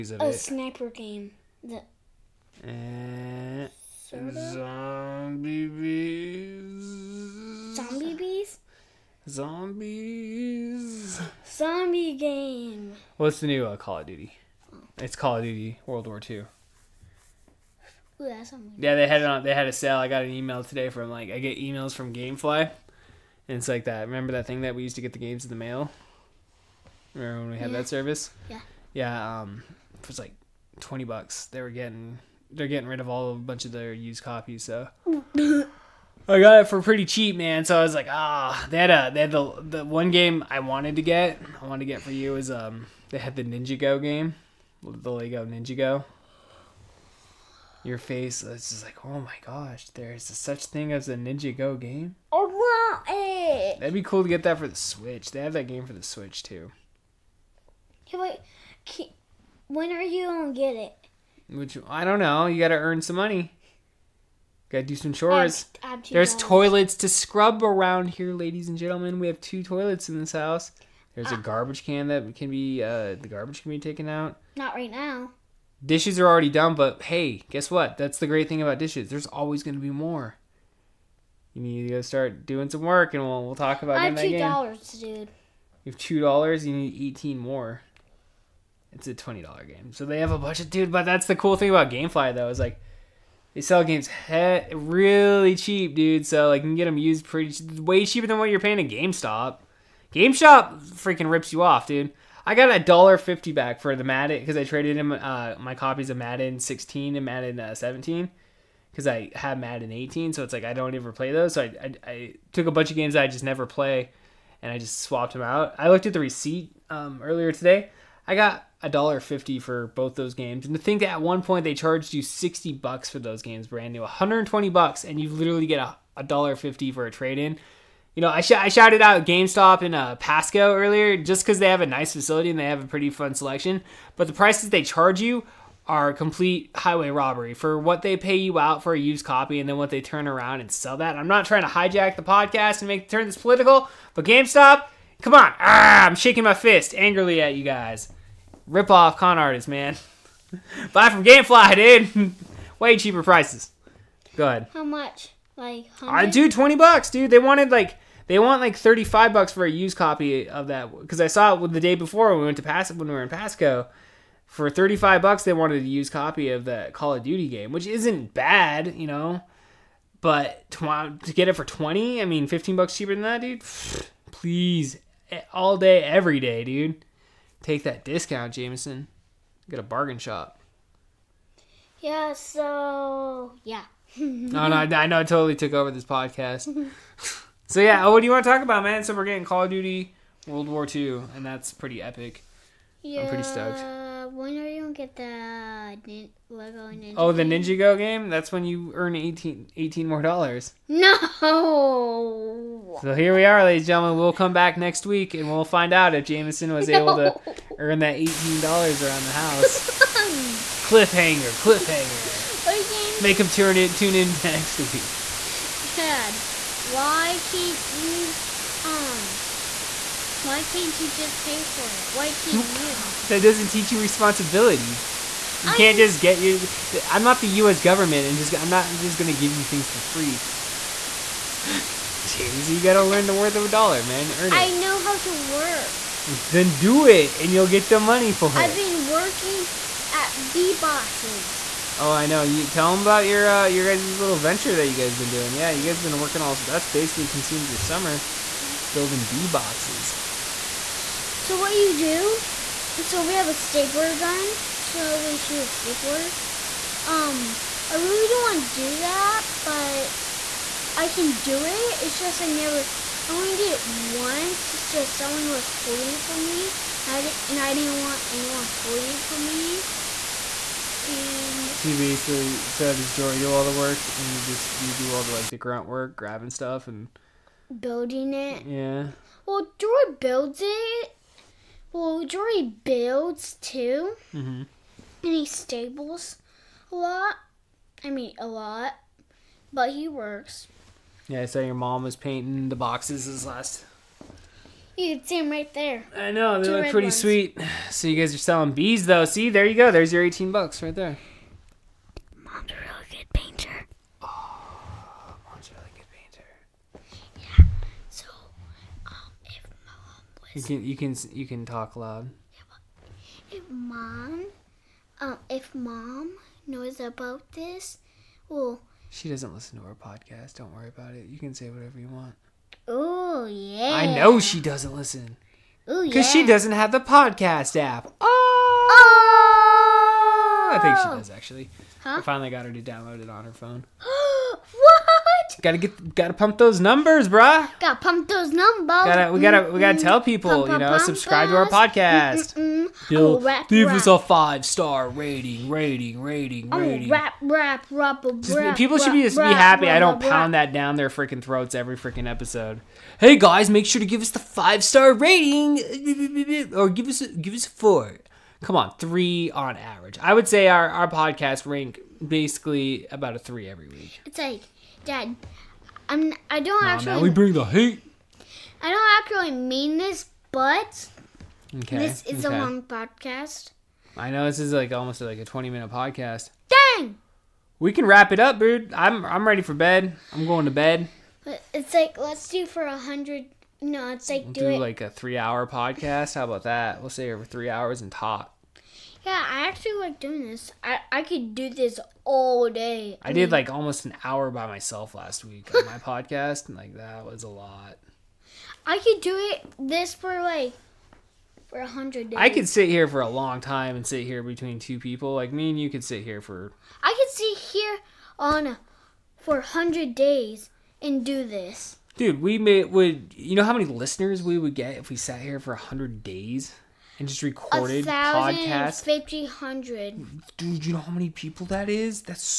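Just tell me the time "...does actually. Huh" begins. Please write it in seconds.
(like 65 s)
331 s.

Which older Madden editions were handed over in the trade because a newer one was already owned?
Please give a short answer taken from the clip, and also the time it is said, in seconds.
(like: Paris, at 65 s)
Madden 16 and 17, at 106 s.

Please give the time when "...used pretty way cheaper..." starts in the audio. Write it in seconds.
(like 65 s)
96 s.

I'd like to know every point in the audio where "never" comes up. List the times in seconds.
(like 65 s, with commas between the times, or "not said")
113 s, 262 s.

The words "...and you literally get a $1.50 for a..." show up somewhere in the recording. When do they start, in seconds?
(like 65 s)
125 s.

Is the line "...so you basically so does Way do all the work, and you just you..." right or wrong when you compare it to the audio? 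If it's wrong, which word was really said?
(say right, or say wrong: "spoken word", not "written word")
wrong: "Jory", not "Way".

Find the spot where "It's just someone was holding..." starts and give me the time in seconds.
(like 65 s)
264 s.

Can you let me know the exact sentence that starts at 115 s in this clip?
I looked at the receipt um, earlier today.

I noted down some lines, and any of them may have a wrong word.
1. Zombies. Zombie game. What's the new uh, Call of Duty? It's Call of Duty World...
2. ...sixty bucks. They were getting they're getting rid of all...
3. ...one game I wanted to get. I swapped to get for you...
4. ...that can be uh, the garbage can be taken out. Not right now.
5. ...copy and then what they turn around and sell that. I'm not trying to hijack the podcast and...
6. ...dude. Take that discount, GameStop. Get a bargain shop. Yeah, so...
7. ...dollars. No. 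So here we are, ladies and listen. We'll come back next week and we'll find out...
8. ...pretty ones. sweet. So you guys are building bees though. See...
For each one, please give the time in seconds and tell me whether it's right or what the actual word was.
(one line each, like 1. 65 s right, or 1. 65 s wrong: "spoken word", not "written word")
1. 9 s right
2. 30 s wrong: "twenty", not "sixty"
3. 39 s wrong: "wanted", not "swapped"
4. 72 s right
5. 139 s right
6. 176 s wrong: "Jamison", not "GameStop"
7. 200 s wrong: "gentlemen", not "listen"
8. 296 s wrong: "selling", not "building".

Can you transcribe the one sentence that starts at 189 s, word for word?
So we're getting Call of Duty, World War II, and that's pretty epic.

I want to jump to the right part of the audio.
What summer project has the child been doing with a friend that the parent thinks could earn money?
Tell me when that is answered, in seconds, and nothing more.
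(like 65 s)
248 s.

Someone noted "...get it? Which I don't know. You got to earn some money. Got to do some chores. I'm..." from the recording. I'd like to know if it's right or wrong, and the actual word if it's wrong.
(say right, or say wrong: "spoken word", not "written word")
right.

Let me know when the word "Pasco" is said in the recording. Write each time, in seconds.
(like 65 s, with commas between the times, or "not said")
130 s, 163 s.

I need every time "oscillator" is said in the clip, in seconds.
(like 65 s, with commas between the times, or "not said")
not said.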